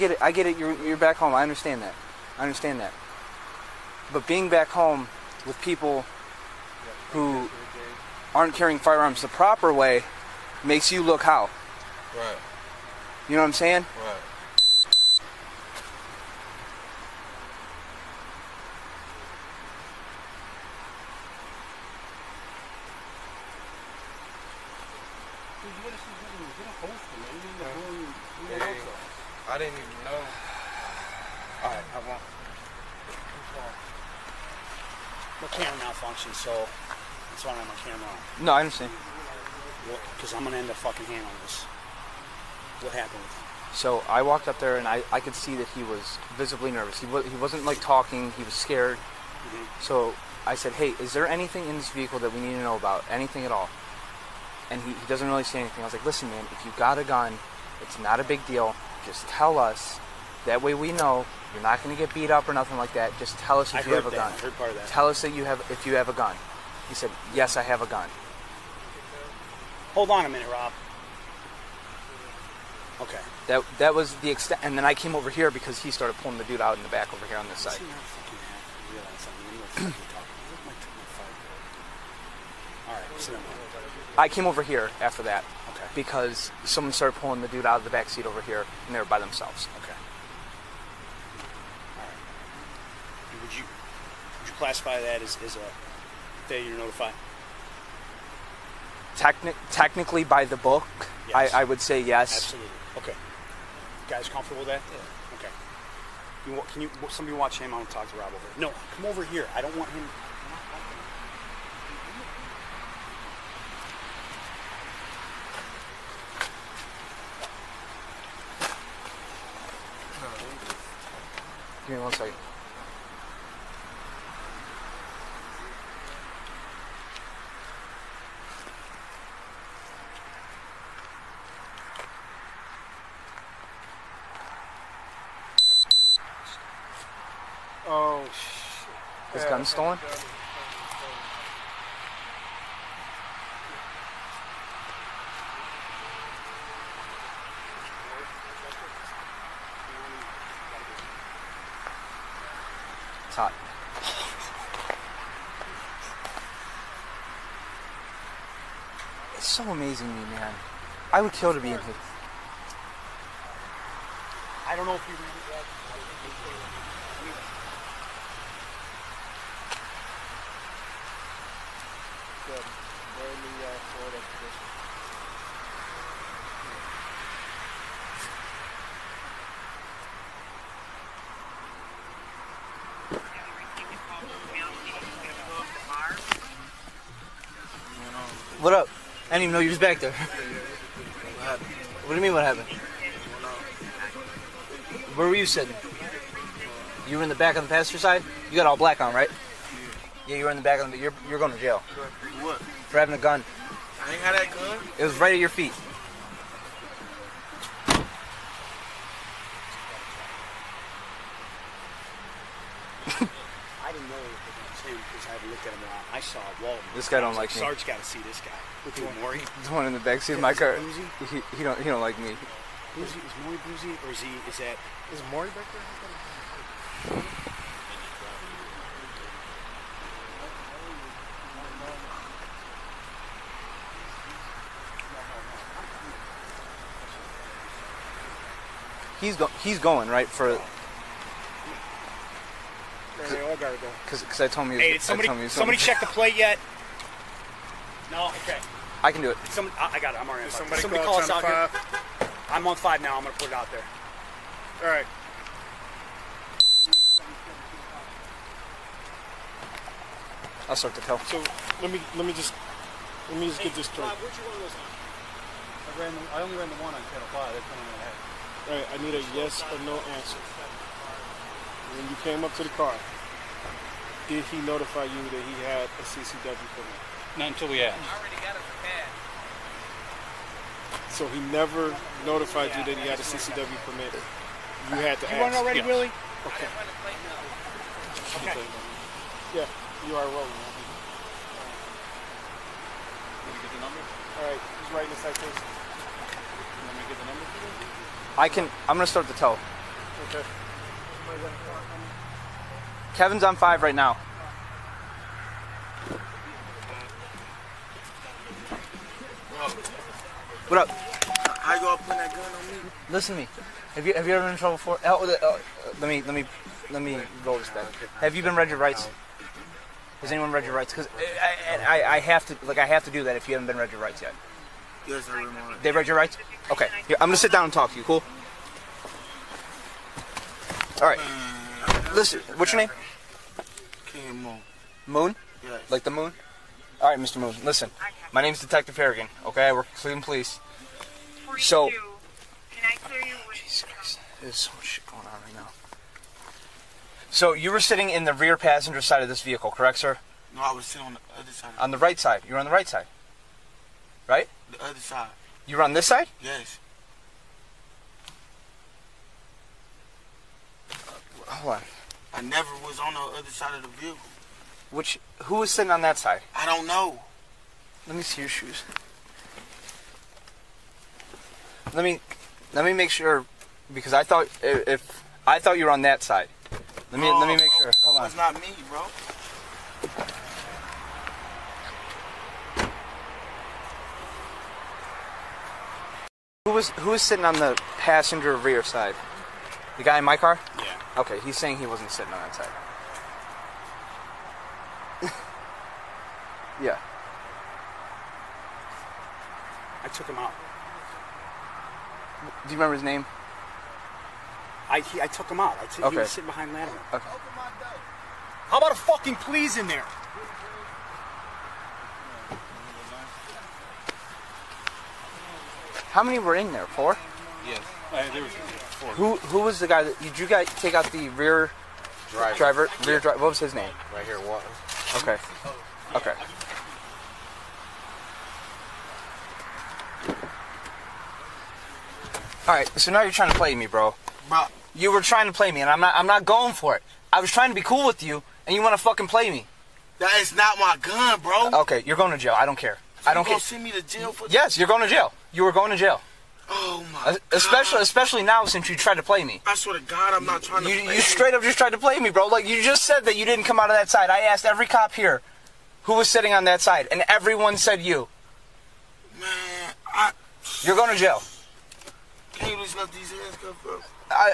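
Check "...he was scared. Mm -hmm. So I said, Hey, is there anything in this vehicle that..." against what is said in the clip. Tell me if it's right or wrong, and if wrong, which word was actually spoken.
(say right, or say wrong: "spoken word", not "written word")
right.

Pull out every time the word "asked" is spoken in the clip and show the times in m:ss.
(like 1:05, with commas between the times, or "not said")
4:37, 7:34.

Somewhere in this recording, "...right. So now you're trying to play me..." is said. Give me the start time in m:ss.
7:12.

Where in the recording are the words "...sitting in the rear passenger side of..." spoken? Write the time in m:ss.
5:47.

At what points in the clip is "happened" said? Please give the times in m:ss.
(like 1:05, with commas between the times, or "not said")
0:42, 3:12.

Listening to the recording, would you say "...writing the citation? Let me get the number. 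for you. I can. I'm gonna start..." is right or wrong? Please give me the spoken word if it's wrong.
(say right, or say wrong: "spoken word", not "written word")
right.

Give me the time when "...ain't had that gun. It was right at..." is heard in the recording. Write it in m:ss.
3:24.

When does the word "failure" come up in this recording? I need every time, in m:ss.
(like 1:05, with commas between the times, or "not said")
1:36.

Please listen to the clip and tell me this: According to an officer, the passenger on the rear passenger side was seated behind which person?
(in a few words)
Lattimore.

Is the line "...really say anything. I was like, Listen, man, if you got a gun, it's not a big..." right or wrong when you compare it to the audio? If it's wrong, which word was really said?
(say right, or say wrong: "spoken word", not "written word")
right.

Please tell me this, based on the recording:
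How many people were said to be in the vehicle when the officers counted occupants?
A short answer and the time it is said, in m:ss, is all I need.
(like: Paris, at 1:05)
4, at 6:56.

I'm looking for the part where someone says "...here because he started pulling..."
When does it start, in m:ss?
1:15.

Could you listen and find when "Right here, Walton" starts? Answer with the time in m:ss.
7:04.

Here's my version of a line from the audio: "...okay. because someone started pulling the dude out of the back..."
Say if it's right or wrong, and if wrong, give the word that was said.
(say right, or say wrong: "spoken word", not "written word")
right.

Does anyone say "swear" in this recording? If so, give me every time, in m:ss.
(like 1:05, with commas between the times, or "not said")
7:29.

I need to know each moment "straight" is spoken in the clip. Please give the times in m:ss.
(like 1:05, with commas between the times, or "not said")
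4:23, 7:31.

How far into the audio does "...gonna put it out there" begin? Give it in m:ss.
4:13.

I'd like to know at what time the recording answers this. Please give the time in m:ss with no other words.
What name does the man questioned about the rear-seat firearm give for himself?
5:34.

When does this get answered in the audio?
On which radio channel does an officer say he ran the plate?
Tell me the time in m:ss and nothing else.
4:27.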